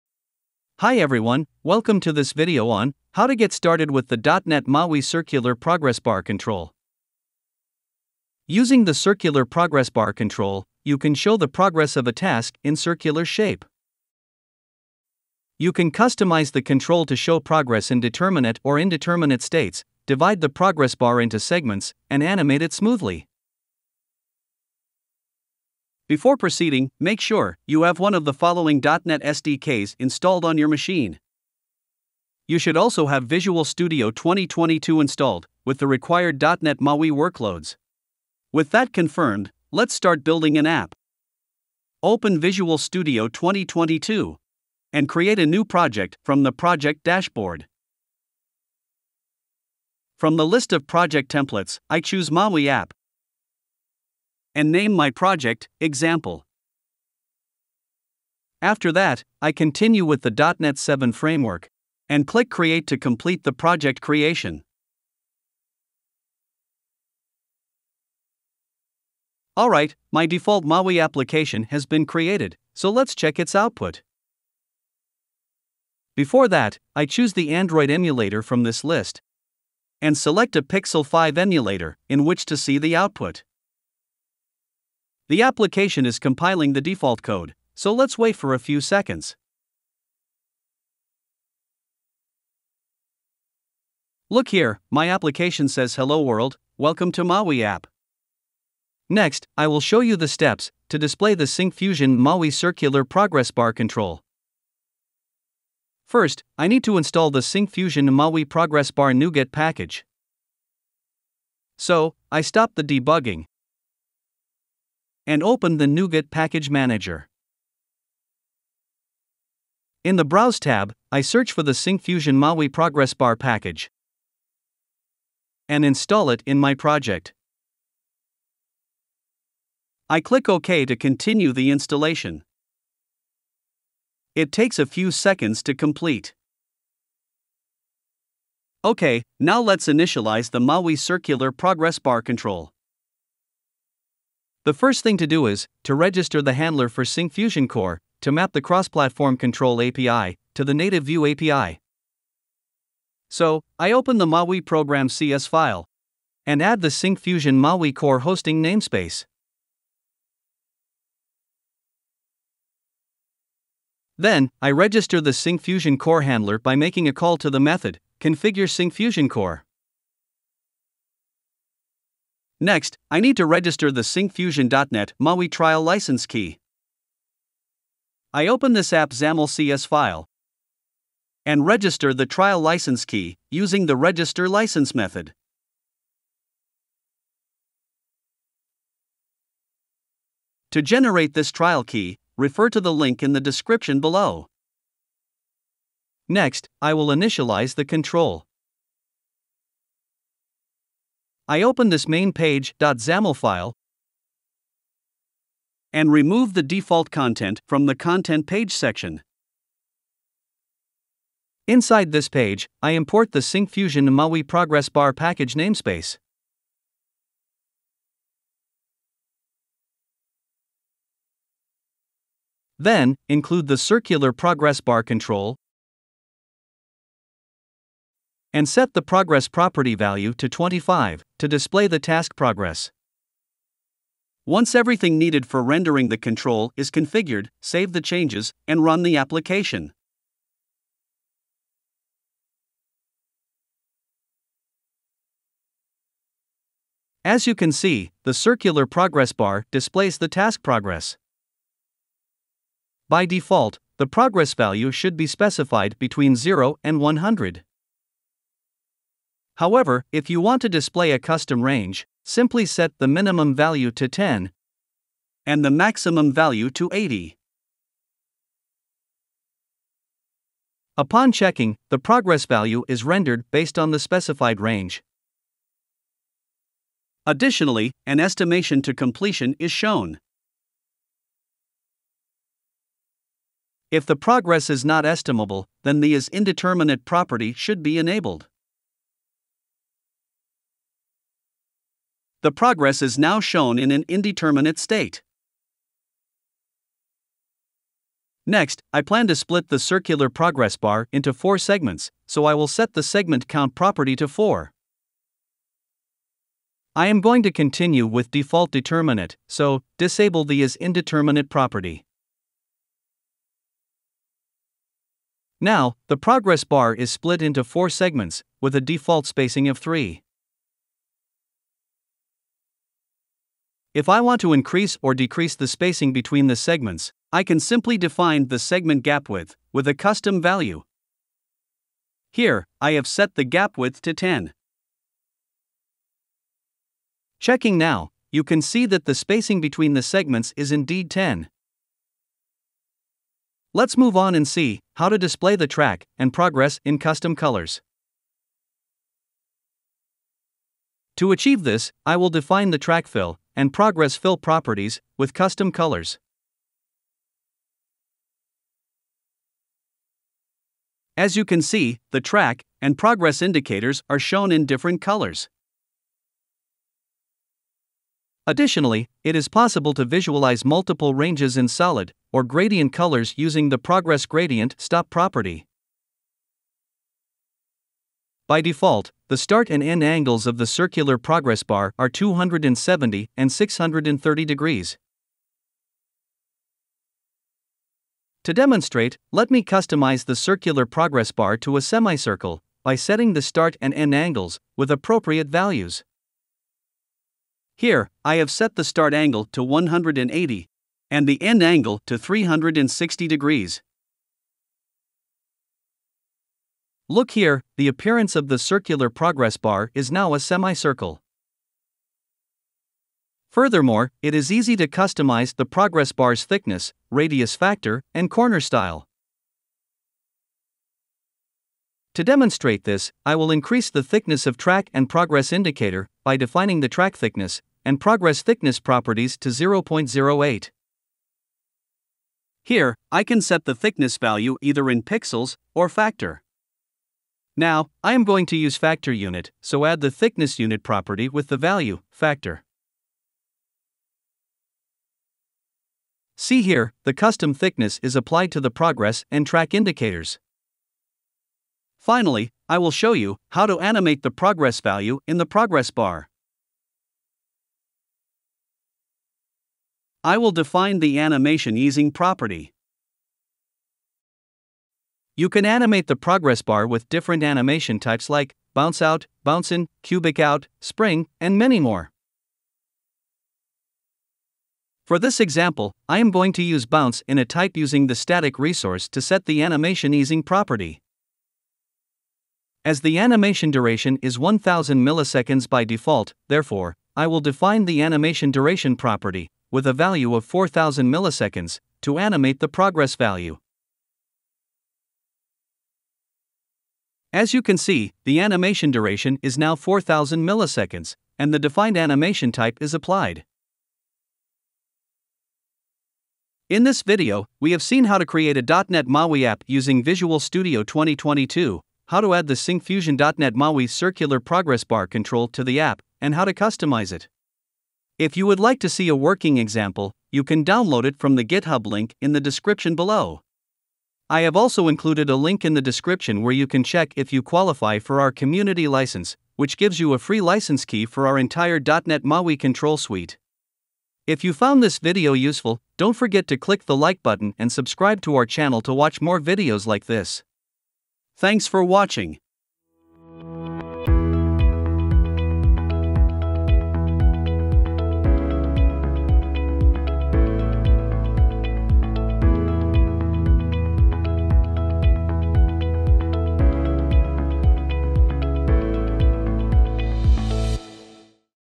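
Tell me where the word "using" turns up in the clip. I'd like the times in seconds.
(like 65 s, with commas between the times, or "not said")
8 s, 183 s, 373 s, 477 s, 509 s.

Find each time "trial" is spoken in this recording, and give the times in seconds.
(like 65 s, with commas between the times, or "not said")
175 s, 182 s, 191 s.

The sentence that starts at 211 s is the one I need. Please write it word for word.
Inside this page, I import the SyncFusion MAUI progress bar package namespace.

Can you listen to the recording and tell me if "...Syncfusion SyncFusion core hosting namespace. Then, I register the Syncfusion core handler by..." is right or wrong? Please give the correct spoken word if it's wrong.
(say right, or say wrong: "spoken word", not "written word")
wrong: "MAUI", not "SyncFusion".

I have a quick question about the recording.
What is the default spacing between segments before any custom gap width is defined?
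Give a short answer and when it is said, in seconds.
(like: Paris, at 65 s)
3, at 319 s.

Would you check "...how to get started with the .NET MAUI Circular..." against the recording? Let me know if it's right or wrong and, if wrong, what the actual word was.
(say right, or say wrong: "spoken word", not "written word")
right.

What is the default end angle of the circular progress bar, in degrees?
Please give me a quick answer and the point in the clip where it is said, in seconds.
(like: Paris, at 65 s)
630, at 383 s.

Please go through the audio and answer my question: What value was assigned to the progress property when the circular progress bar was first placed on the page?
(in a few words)
25.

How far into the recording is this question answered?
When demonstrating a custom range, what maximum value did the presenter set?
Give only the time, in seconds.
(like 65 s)
266 s.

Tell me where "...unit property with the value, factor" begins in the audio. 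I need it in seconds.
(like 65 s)
440 s.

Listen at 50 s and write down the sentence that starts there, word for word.
From the list of project templates, I choose MAUI app and name my project, example.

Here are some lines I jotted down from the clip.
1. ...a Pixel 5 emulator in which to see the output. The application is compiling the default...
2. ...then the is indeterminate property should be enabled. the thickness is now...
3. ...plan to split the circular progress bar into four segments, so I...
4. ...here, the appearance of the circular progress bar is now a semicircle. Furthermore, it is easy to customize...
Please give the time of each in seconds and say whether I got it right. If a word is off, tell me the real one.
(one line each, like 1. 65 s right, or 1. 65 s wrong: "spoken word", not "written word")
1. 80 s right
2. 285 s wrong: "progress", not "thickness"
3. 299 s right
4. 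407 s right.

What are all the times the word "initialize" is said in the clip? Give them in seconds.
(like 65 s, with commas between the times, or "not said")
139 s, 197 s.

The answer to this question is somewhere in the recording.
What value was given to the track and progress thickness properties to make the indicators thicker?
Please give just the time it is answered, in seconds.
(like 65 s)
429 s.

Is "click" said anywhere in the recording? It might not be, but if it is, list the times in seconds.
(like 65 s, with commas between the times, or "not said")
62 s, 130 s, 536 s.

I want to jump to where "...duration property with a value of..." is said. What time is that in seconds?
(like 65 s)
488 s.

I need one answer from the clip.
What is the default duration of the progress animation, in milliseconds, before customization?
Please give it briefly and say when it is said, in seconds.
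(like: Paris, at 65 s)
1000, at 484 s.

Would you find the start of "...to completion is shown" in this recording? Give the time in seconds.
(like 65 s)
278 s.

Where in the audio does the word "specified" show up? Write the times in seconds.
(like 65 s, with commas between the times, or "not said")
255 s, 273 s.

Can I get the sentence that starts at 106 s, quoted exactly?
First, I need to install the Syncfusion Maui Progress Bar NuGet package.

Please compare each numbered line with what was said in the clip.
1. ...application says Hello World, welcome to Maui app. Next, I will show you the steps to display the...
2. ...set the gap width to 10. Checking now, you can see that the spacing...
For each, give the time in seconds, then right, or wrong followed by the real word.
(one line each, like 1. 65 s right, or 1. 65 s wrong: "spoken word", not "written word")
1. 95 s right
2. 333 s right.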